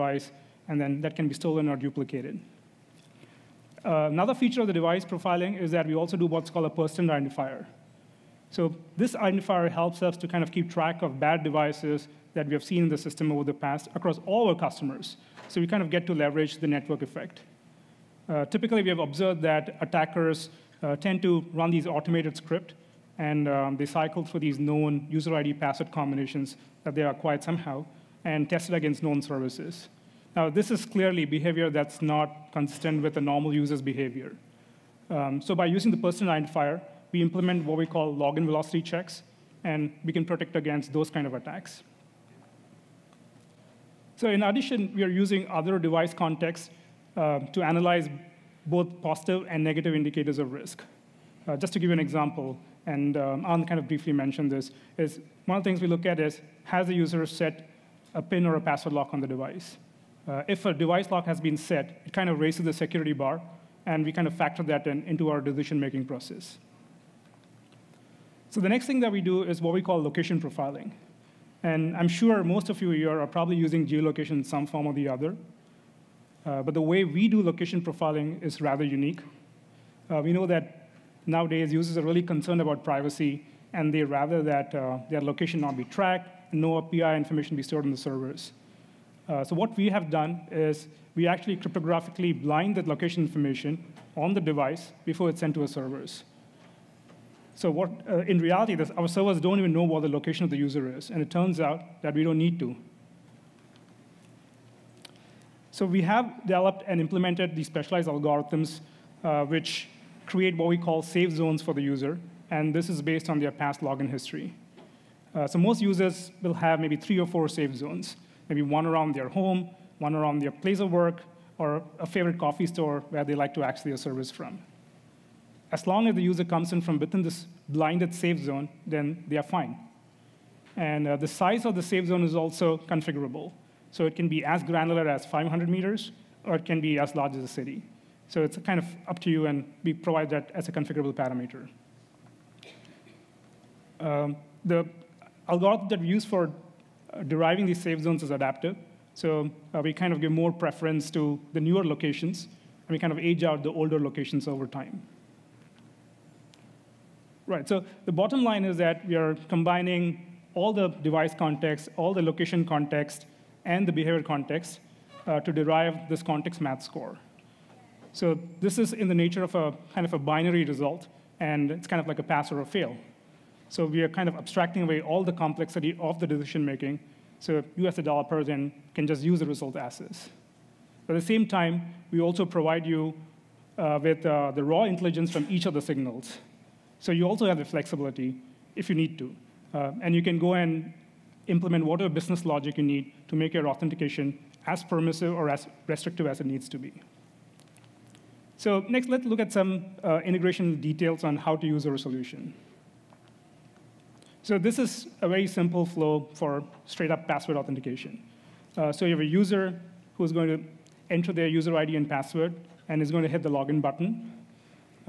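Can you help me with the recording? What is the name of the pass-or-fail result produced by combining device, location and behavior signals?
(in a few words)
context match score.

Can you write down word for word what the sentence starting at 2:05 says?
As long as the user comes in from within this blinded safe zone, then they are fine.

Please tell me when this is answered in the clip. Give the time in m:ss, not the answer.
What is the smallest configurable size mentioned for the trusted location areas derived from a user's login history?
2:15.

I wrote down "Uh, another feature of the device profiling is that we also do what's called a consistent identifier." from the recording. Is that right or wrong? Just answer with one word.
wrong.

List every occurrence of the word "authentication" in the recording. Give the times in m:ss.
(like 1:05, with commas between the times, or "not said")
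3:13, 3:27.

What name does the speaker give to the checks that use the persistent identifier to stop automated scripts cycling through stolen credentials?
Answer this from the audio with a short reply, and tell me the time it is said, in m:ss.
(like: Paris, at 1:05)
login velocity checks, at 0:38.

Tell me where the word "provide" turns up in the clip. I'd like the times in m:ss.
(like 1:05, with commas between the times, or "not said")
2:19, 3:02.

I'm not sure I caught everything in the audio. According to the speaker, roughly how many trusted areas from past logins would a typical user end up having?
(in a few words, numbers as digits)
3 or 4.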